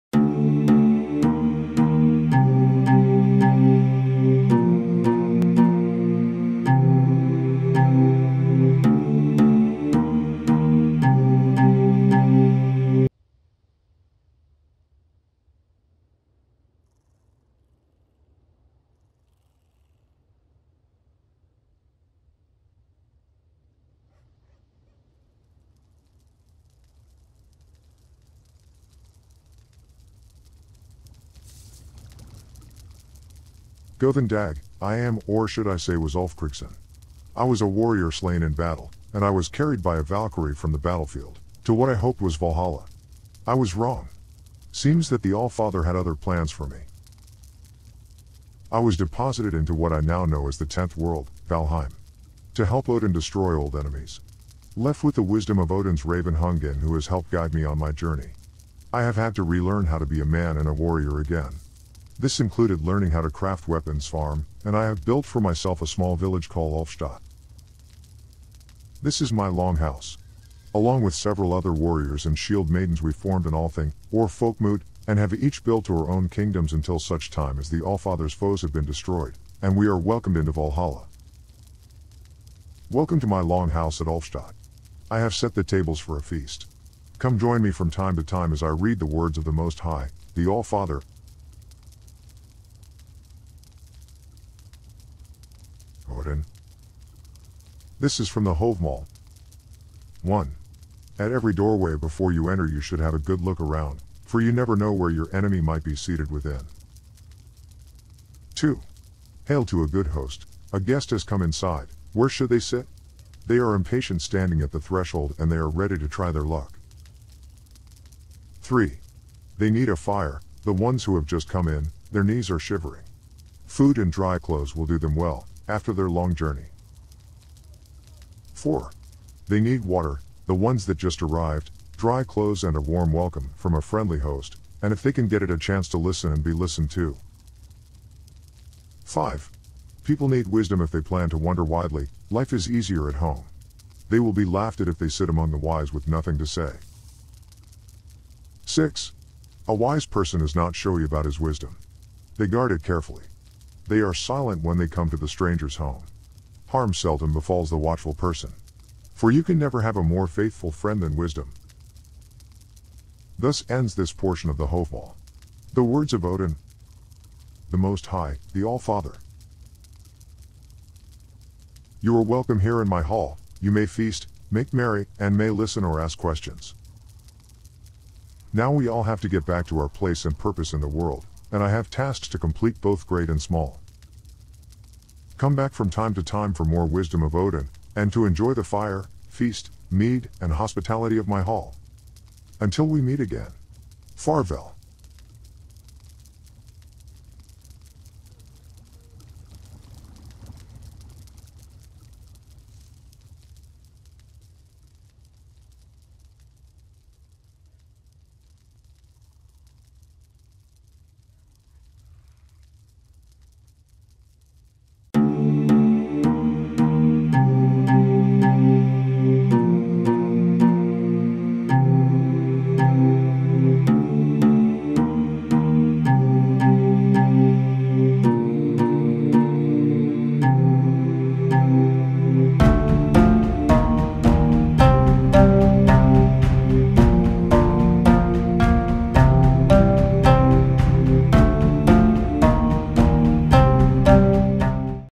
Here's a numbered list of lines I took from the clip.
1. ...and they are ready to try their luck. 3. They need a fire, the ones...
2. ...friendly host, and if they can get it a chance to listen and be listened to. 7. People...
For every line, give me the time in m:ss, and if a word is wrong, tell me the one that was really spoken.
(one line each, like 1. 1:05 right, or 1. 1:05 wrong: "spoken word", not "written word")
1. 1:55 right
2. 2:13 wrong: "5", not "7".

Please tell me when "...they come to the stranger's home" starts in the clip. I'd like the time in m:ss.
2:34.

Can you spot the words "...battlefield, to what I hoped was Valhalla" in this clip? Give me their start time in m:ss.
0:40.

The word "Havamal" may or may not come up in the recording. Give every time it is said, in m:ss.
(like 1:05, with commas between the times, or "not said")
1:38, 2:44.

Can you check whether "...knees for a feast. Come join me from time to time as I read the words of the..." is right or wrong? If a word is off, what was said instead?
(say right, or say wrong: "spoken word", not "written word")
wrong: "tables", not "knees".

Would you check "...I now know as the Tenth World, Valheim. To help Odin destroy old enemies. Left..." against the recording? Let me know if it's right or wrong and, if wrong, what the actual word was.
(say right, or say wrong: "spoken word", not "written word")
right.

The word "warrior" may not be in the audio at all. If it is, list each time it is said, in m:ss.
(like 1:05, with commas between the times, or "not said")
0:37, 1:00, 1:11.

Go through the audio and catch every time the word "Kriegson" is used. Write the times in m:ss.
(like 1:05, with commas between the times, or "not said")
0:36.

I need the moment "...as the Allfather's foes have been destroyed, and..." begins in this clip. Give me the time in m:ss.
1:17.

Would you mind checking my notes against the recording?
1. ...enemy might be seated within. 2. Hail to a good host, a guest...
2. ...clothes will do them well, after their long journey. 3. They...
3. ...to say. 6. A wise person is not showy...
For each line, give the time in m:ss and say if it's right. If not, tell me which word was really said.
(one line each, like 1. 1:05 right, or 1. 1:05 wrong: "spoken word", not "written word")
1. 1:45 right
2. 2:04 wrong: "4", not "3"
3. 2:26 right.